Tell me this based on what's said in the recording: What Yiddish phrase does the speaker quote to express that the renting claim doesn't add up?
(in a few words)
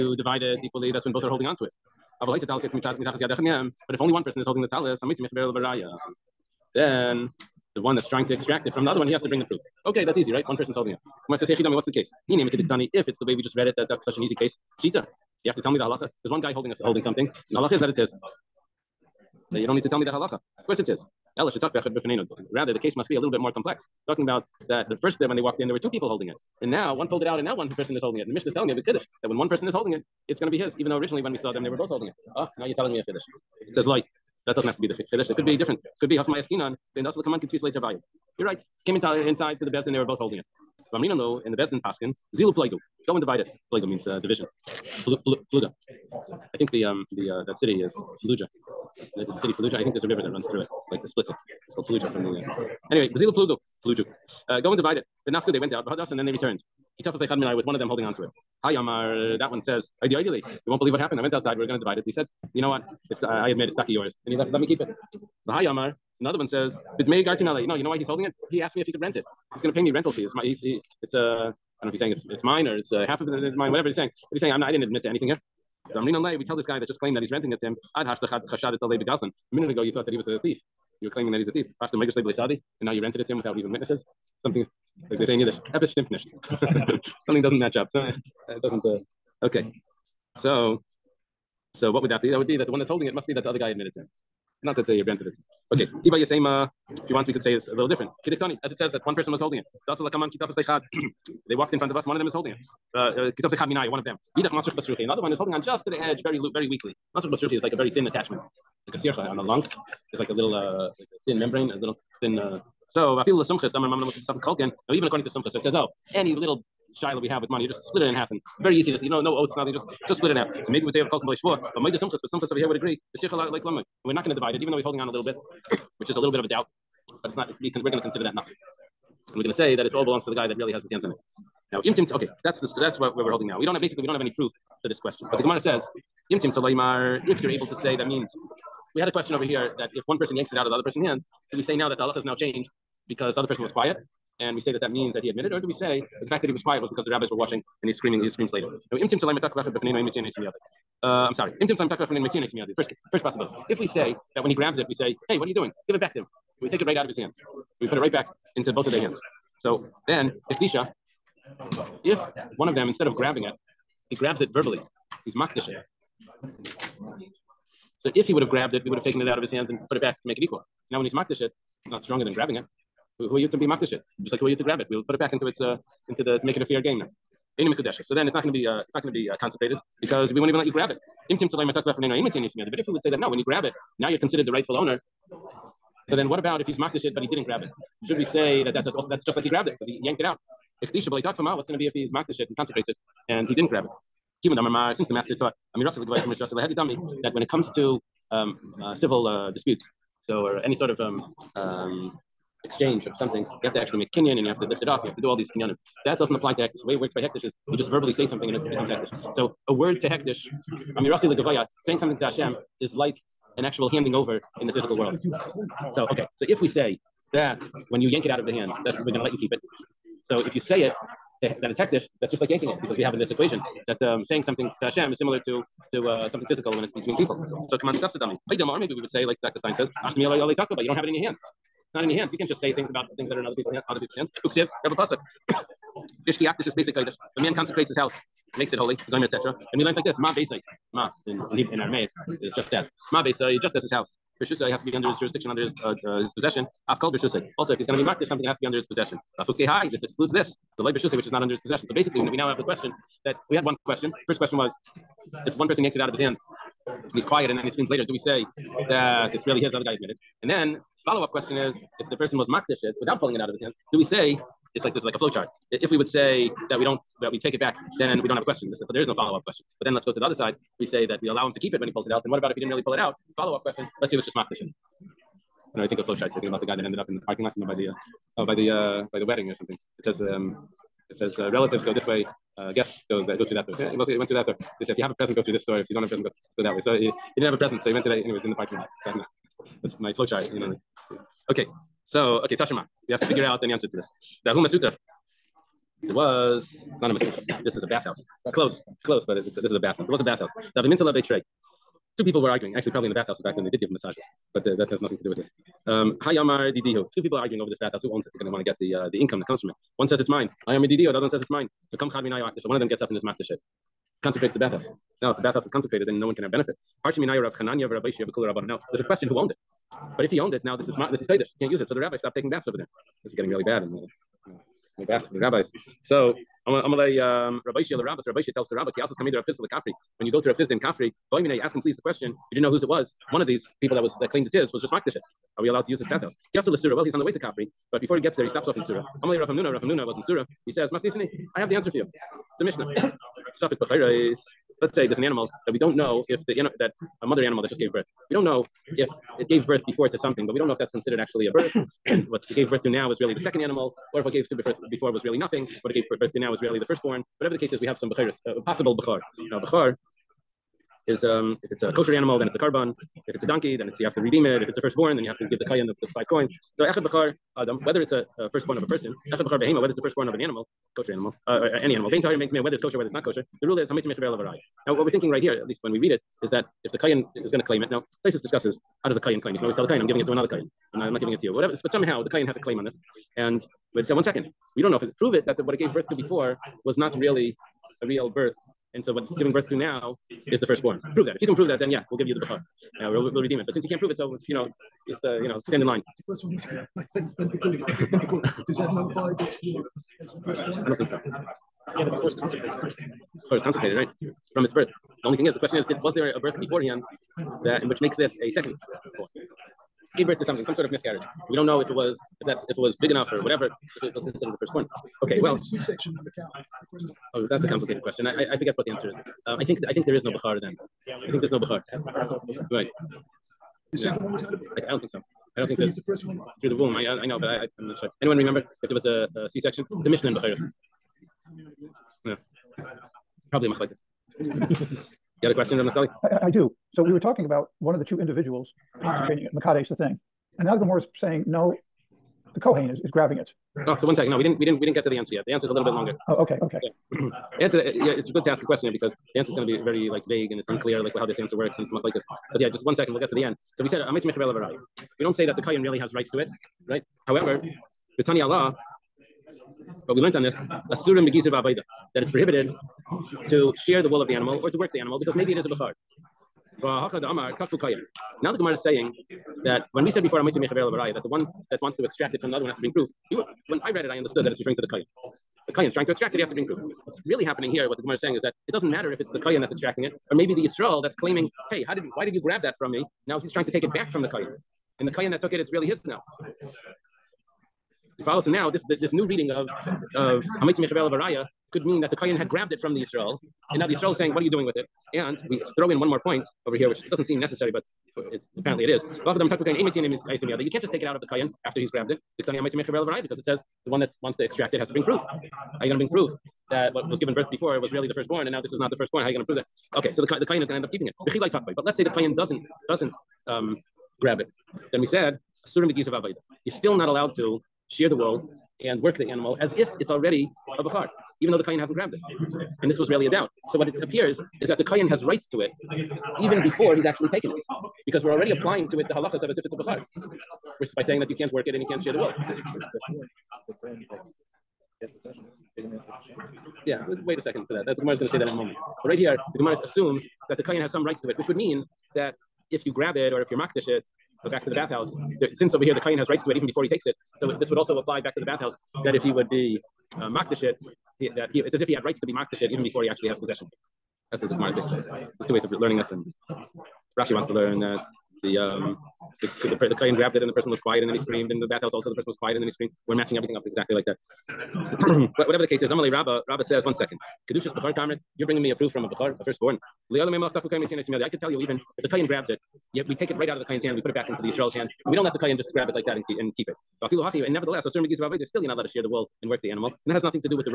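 episch stimmt nicht.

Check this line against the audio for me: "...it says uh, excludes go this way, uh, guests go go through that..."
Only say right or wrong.
wrong.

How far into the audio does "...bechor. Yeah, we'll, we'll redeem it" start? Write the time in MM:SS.
06:32.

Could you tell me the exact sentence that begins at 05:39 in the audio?
Amalei Rav Hamnuna, Rav Hamnuna was in Surah.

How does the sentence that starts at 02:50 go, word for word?
So now when he's makdasha, it's not stronger than grabbing it.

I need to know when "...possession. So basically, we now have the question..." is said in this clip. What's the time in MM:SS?
04:11.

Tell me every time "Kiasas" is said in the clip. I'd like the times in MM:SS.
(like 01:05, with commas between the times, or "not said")
05:28, 05:36.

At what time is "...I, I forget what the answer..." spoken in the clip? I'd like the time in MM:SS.
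06:58.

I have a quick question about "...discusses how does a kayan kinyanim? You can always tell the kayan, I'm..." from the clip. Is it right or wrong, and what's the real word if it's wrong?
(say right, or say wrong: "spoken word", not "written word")
wrong: "claim", not "kinyanim".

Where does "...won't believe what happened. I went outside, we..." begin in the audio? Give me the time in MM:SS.
01:00.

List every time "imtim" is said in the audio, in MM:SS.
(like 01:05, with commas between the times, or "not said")
02:11, 02:16.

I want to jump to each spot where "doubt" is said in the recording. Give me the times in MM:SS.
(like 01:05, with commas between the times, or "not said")
02:06, 08:43.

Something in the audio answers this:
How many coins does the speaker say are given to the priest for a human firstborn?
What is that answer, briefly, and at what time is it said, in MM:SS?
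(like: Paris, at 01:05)
5, at 06:06.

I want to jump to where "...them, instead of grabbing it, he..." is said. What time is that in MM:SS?
02:42.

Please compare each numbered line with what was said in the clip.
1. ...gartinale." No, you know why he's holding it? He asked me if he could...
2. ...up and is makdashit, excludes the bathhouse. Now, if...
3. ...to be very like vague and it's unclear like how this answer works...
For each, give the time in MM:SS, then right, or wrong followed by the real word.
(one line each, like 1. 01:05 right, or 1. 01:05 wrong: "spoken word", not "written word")
1. 01:07 right
2. 05:13 wrong: "consecrates", not "excludes"
3. 07:29 right.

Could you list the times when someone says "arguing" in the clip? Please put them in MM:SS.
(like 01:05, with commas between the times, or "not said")
05:02, 05:07.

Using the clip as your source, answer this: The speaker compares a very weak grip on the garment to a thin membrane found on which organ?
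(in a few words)
lung.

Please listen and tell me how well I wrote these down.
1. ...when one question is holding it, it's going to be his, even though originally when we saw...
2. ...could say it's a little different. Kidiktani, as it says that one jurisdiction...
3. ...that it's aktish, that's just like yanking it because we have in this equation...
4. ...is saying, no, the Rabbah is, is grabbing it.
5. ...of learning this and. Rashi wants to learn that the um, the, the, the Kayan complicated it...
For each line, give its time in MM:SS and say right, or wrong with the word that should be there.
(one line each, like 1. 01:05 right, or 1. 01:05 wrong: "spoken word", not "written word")
1. 00:29 wrong: "person", not "question"
2. 01:37 wrong: "person", not "jurisdiction"
3. 03:41 wrong: "hektish", not "aktish"
4. 07:21 wrong: "Kohen", not "Rabbah"
5. 09:15 wrong: "grabbed", not "complicated".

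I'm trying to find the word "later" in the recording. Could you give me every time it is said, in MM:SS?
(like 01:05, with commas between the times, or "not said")
02:28, 04:17.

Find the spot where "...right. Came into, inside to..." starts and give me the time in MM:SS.
00:38.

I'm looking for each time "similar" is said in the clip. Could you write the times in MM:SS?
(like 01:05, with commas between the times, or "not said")
03:45.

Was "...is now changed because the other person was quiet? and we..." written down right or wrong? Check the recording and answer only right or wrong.
right.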